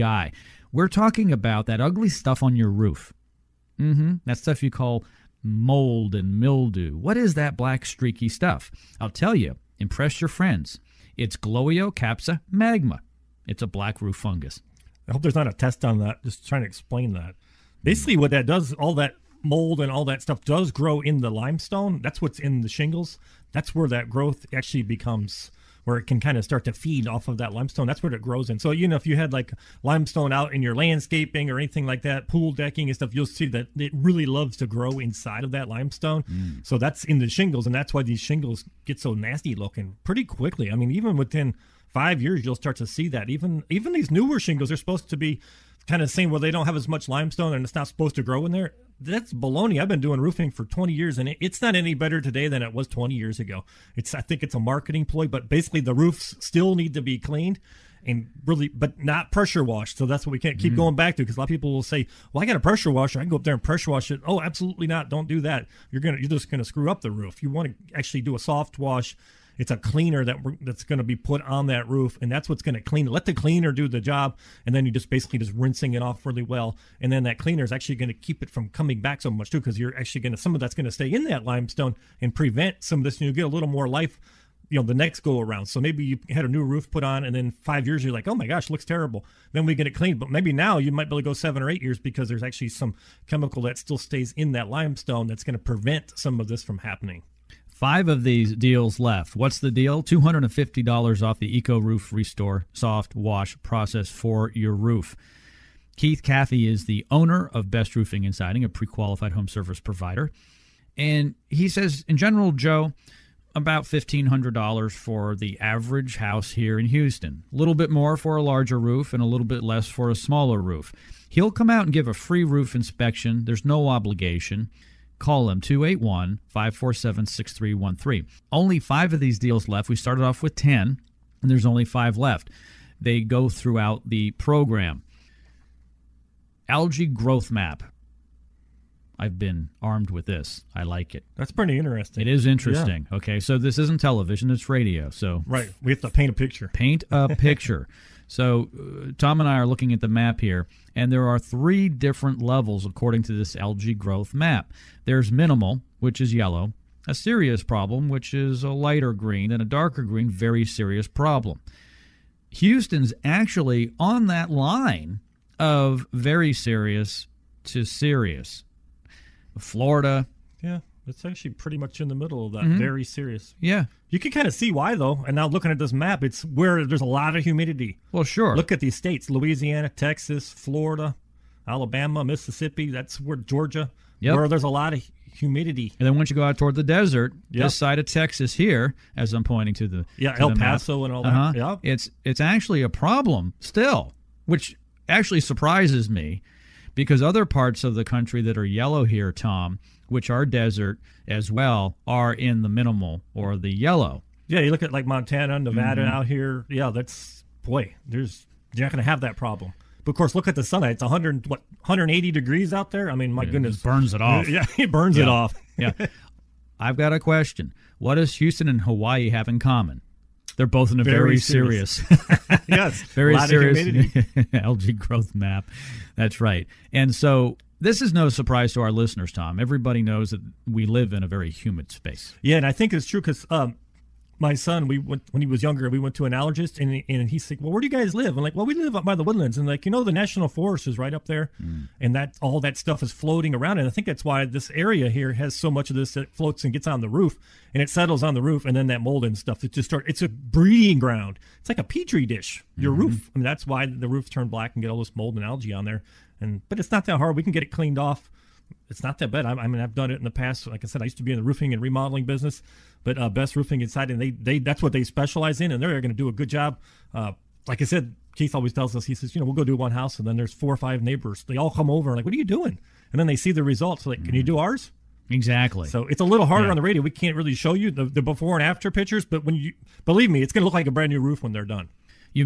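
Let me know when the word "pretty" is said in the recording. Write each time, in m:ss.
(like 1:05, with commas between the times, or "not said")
0:40, 2:21, 2:51.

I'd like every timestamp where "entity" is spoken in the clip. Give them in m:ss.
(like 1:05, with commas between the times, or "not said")
not said.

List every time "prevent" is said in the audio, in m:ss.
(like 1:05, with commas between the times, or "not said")
1:22, 1:35.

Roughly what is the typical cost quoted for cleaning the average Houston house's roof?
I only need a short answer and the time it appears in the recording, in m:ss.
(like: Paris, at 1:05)
$1,500, at 1:53.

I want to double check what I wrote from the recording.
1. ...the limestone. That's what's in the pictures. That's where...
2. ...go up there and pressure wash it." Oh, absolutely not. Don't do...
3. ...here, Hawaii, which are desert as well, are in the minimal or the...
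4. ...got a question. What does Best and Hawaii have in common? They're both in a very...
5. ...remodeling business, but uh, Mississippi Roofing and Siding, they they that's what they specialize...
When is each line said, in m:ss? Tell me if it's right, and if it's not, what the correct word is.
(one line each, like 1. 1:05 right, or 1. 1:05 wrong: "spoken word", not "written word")
1. 0:21 wrong: "shingles", not "pictures"
2. 1:03 right
3. 3:19 wrong: "Tom", not "Hawaii"
4. 3:36 wrong: "Houston", not "Best"
5. 4:21 wrong: "Best", not "Mississippi".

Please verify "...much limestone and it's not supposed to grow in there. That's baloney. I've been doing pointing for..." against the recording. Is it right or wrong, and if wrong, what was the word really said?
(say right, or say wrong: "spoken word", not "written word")
wrong: "roofing", not "pointing".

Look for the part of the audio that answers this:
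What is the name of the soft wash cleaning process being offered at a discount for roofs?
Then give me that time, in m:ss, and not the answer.
1:41.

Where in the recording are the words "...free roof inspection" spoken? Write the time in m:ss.
2:02.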